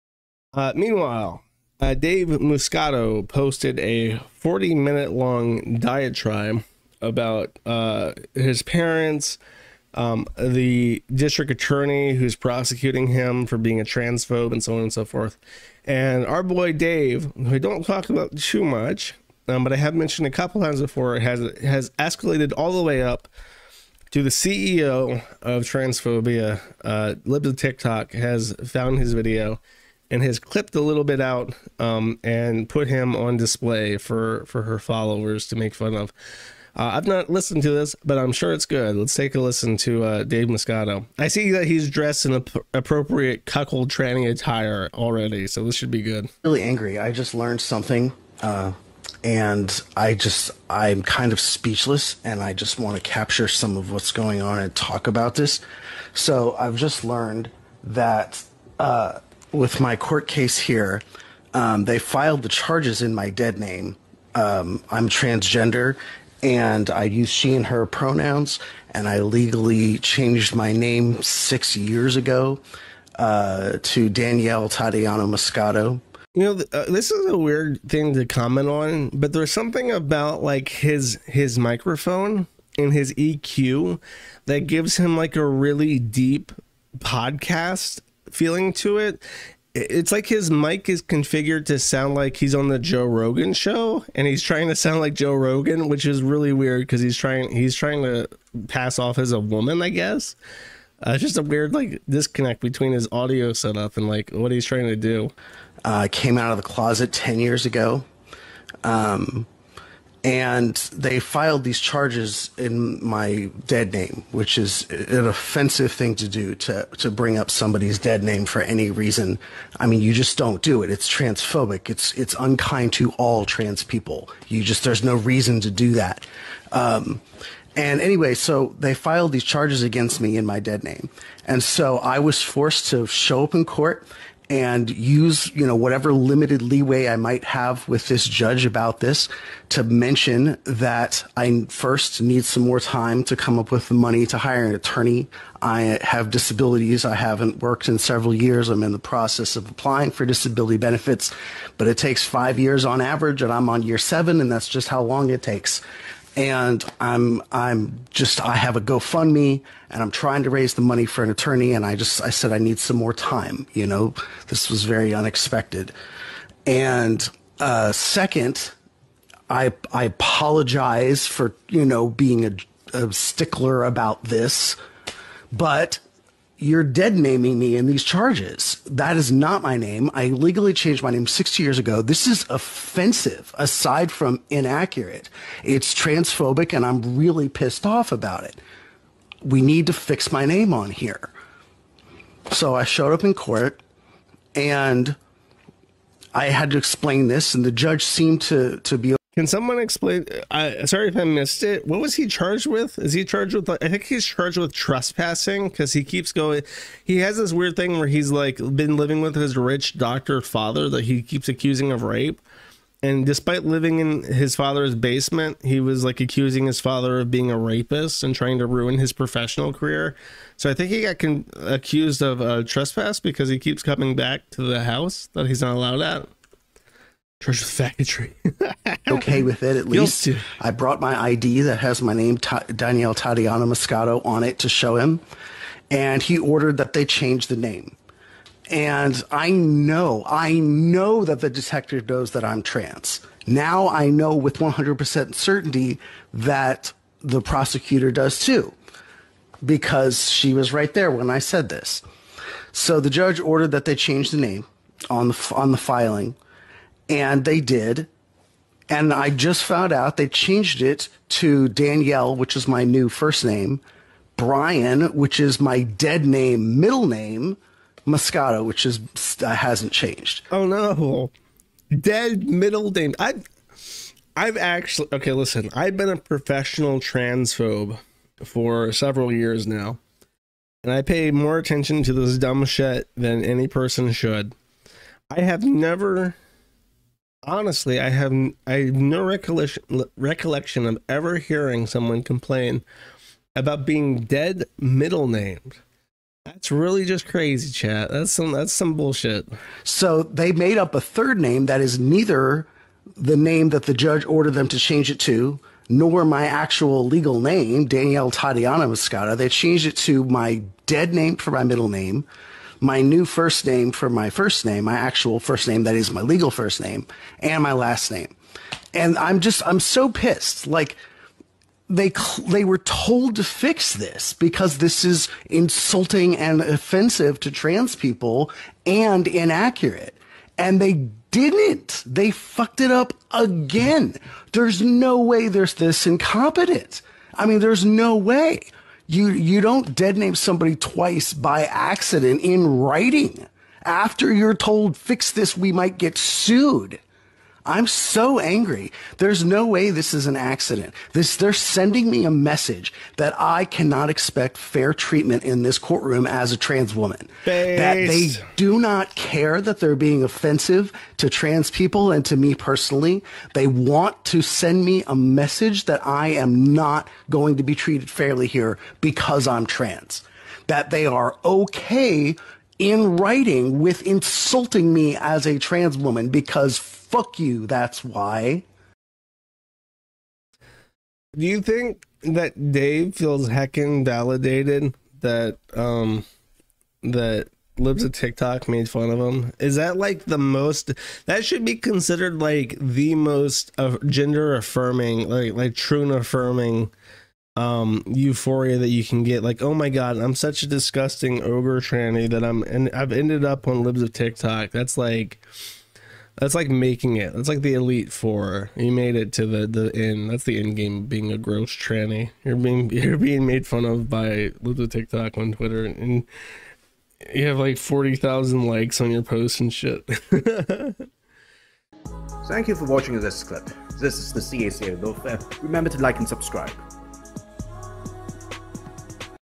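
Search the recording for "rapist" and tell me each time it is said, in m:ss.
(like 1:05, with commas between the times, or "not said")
3:37.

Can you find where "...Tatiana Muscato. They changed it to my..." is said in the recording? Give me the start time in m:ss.
5:08.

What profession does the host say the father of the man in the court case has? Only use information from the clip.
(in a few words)
Doctor.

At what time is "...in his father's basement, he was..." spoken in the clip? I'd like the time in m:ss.
3:33.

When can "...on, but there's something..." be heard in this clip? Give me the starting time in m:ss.
1:18.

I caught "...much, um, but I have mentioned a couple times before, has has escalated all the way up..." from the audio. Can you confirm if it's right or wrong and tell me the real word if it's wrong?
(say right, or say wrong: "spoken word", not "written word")
right.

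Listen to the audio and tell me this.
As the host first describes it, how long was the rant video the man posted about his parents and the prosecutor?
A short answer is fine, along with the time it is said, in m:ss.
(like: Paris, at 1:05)
40 minutes, at 0:04.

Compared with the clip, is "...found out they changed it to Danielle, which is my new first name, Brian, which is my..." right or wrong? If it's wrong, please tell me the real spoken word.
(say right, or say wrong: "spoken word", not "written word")
right.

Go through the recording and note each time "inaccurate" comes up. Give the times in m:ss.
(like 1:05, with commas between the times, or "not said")
3:04, 5:29.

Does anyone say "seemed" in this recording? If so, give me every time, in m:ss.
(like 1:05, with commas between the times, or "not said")
3:18.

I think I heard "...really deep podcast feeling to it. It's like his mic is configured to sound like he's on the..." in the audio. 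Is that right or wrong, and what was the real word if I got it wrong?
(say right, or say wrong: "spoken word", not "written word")
right.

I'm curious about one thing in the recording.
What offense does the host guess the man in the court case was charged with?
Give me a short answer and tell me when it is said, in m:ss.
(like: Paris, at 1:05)
Trespassing, at 3:24.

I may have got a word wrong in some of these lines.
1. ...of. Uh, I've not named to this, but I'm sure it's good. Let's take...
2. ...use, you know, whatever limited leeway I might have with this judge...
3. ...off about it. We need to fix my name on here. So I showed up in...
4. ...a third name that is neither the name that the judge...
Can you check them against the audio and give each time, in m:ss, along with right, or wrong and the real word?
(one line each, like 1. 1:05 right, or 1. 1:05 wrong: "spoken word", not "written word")
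1. 0:35 wrong: "listened", not "named"
2. 2:14 right
3. 3:07 right
4. 5:00 right.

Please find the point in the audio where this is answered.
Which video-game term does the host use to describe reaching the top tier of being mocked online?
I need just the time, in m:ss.
6:47.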